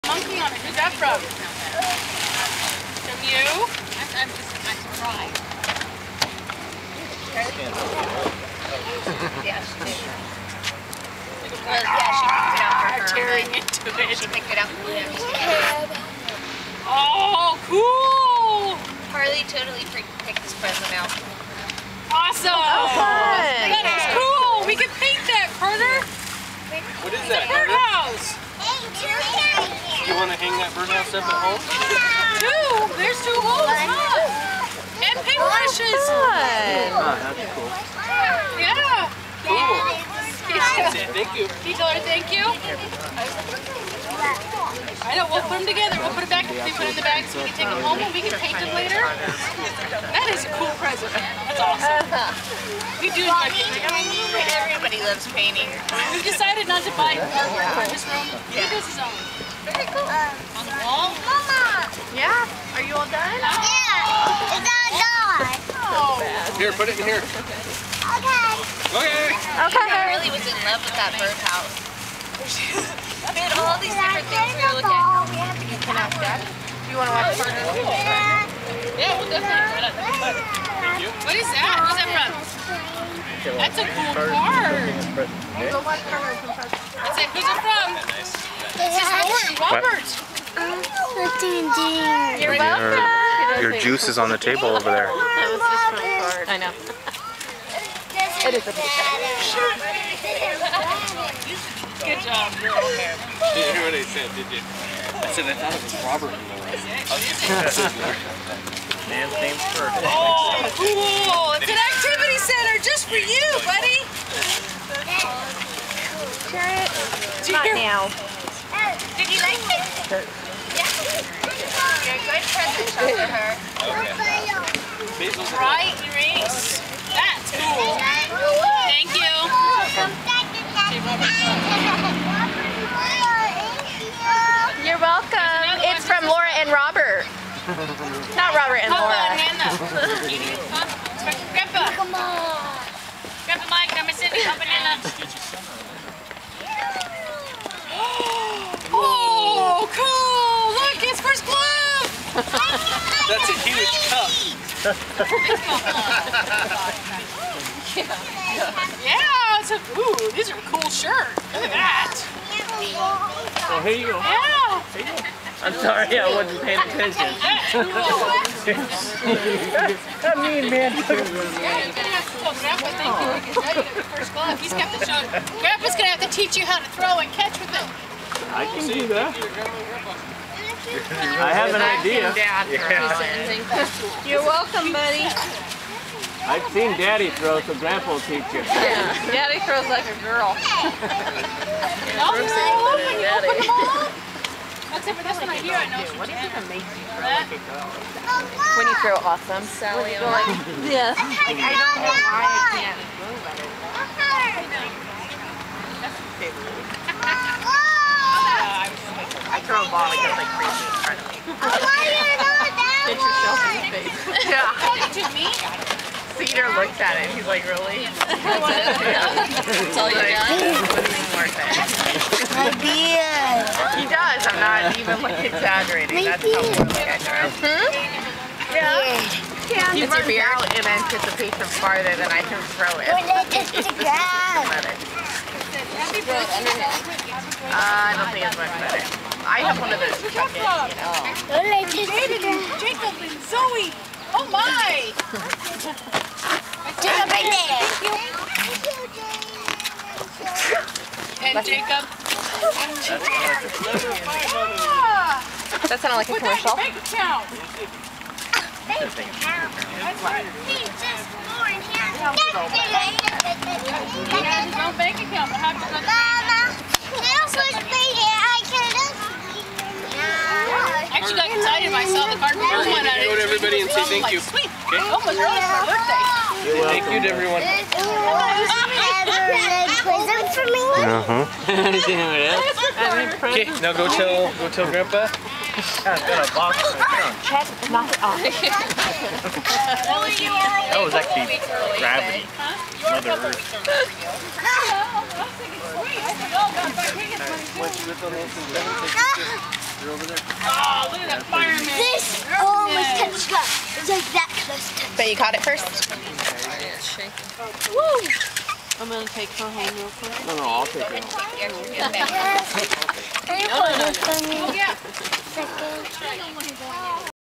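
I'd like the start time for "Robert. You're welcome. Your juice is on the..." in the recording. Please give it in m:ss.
1:30.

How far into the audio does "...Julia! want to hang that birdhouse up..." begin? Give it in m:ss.
0:29.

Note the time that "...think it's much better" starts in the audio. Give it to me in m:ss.
3:58.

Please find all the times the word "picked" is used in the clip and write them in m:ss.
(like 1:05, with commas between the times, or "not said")
0:09, 0:14, 0:19.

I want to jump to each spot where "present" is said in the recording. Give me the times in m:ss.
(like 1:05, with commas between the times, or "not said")
0:20, 0:50, 2:02.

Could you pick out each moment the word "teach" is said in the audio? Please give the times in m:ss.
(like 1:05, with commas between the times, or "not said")
2:56, 3:08.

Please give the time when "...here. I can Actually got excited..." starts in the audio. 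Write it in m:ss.
4:28.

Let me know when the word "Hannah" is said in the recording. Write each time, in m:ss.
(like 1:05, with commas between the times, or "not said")
2:19, 2:24.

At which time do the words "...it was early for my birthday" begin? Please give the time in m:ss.
4:35.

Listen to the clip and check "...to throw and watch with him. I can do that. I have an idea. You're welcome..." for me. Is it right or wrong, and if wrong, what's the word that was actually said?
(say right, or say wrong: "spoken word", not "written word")
wrong: "catch", not "watch".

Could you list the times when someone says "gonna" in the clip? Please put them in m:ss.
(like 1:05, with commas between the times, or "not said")
2:55, 5:09.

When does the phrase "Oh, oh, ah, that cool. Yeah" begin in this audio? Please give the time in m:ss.
0:36.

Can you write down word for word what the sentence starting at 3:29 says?
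I throw a ball and goes like crazy in front of me.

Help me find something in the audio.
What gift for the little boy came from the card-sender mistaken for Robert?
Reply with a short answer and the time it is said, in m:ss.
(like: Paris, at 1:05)
Activity center, at 1:51.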